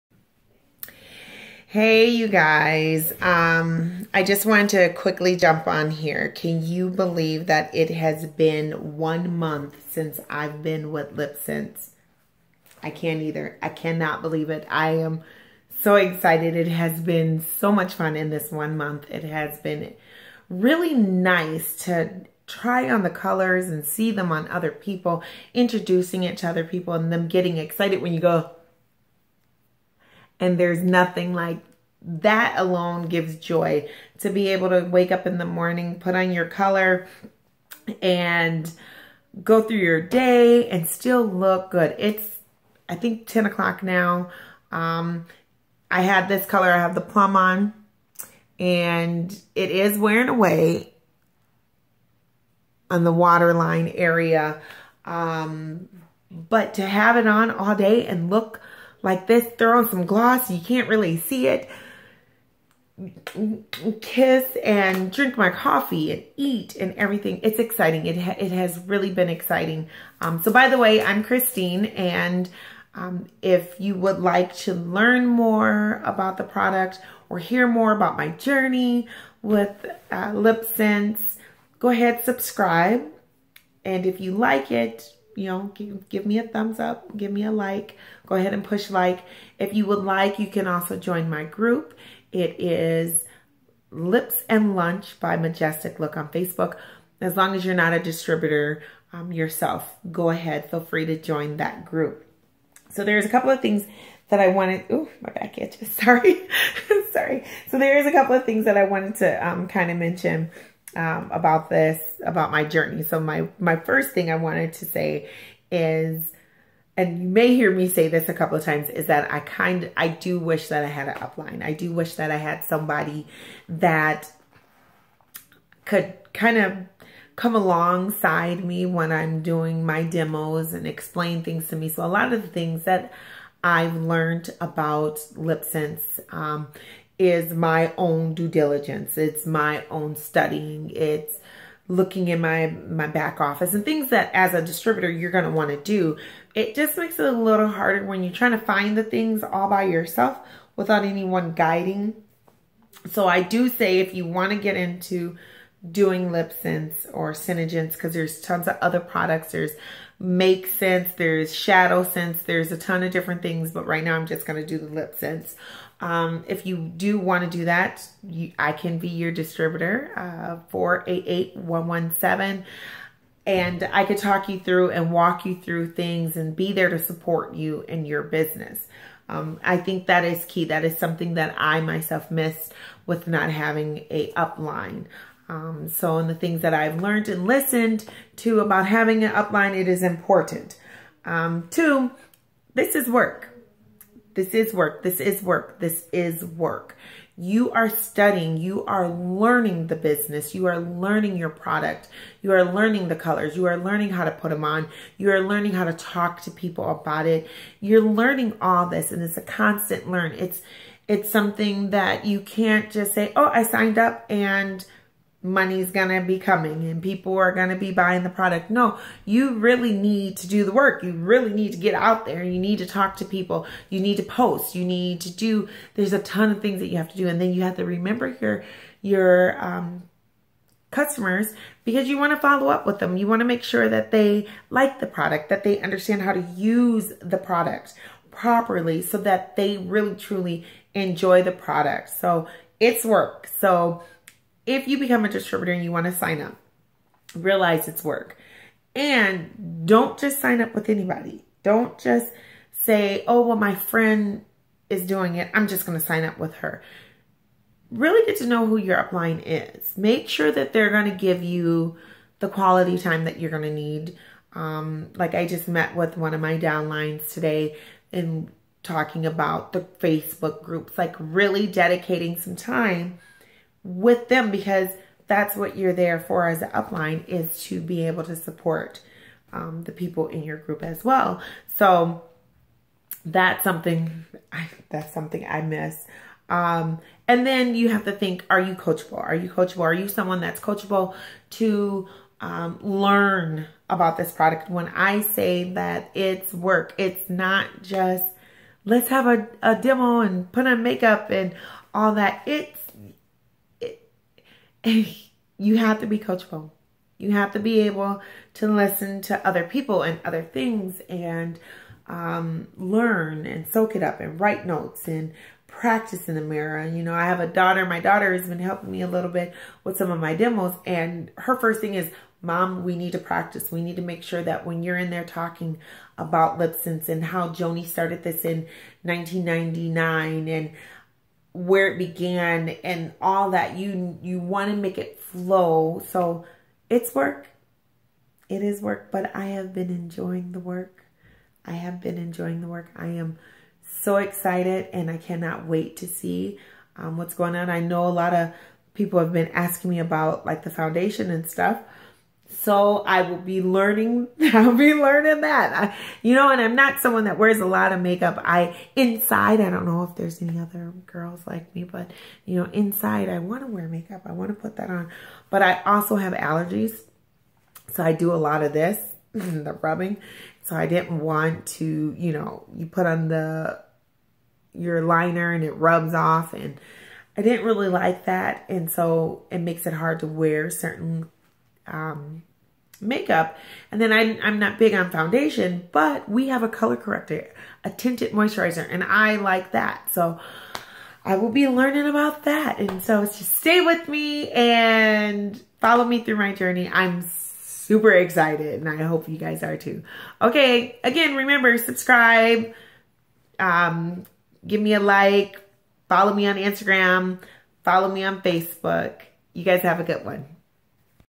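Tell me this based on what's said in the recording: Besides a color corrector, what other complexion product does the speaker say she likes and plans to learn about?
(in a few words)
tinted moisturizer.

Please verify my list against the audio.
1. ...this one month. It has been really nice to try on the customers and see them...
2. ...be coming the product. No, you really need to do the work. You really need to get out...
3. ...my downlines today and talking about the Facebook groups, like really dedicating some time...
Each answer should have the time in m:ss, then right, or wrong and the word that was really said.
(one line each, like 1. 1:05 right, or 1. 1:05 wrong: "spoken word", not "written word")
1. 0:18 wrong: "colors", not "customers"
2. 3:37 wrong: "buying", not "coming"
3. 4:26 right.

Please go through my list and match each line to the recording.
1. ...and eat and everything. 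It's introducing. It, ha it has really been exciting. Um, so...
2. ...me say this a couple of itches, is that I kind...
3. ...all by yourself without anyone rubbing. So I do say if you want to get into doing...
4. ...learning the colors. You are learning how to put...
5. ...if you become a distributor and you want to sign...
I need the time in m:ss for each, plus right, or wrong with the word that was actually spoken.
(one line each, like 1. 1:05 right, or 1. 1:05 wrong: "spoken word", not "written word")
1. 1:06 wrong: "exciting", not "introducing"
2. 1:57 wrong: "times", not "itches"
3. 2:29 wrong: "guiding", not "rubbing"
4. 3:22 right
5. 4:04 right.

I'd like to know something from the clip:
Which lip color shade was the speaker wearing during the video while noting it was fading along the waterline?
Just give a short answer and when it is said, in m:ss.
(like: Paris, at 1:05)
plum, at 0:47.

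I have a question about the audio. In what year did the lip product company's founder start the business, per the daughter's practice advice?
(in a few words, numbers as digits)
1999.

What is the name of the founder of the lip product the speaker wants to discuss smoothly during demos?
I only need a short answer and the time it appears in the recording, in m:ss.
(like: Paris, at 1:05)
Joni, at 5:27.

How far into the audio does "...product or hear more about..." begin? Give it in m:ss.
1:16.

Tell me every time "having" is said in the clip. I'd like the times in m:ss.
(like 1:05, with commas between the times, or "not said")
3:03, 3:08.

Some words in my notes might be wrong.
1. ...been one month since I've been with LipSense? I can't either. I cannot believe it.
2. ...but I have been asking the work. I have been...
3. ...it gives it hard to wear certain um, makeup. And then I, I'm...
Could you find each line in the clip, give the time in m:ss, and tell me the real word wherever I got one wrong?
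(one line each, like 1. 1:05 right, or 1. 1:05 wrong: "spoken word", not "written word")
1. 0:08 right
2. 5:39 wrong: "enjoying", not "asking"
3. 6:19 wrong: "makes", not "gives".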